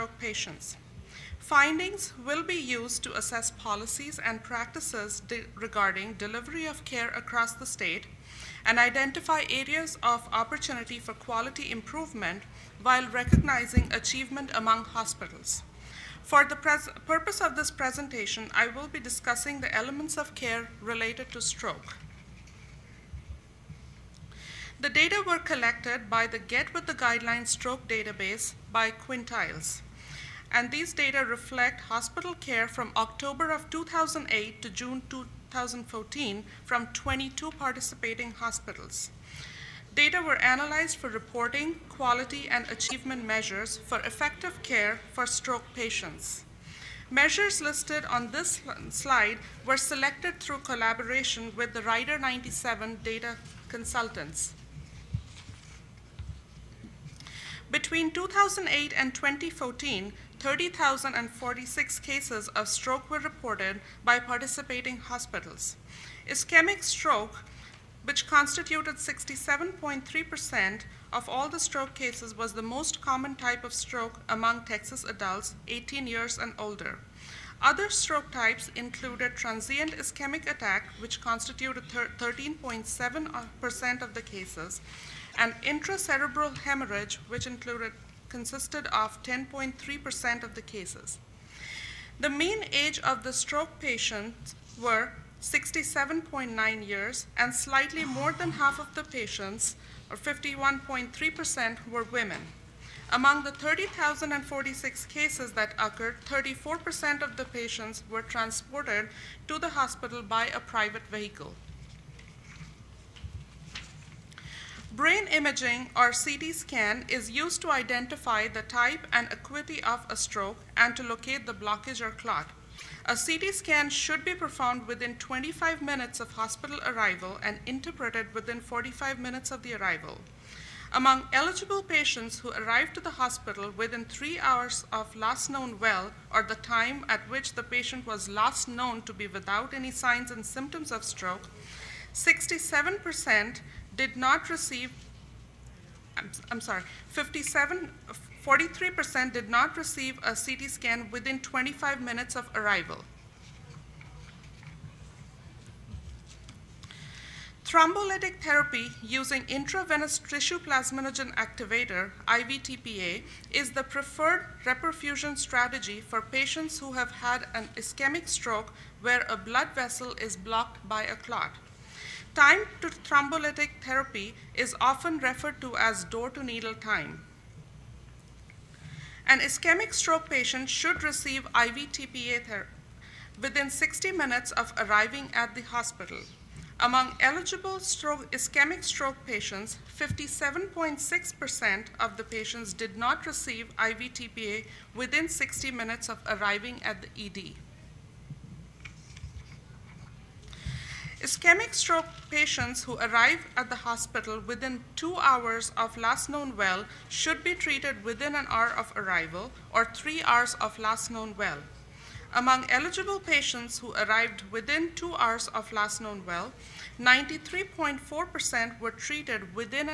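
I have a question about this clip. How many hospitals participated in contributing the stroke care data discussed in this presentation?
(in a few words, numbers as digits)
22.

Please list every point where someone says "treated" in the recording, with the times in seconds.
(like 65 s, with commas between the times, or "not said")
207 s, 218 s.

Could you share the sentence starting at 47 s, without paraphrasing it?
Measures listed on this slide were selected through collaboration with the RIDER 97 data consultants.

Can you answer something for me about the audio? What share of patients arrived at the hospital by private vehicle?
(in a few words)
34%.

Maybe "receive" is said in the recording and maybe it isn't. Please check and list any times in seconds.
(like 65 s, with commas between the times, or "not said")
144 s, 149 s, 181 s, 193 s.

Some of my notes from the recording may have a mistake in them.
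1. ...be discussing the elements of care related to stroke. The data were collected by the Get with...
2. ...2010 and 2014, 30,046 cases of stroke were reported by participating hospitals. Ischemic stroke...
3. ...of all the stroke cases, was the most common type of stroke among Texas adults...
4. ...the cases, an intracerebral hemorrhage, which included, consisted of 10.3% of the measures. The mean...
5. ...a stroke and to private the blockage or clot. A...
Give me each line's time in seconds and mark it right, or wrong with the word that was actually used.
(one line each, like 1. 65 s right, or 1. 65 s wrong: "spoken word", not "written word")
1. 18 s right
2. 58 s wrong: "2008", not "2010"
3. 71 s right
4. 84 s wrong: "cases", not "measures"
5. 120 s wrong: "locate", not "private".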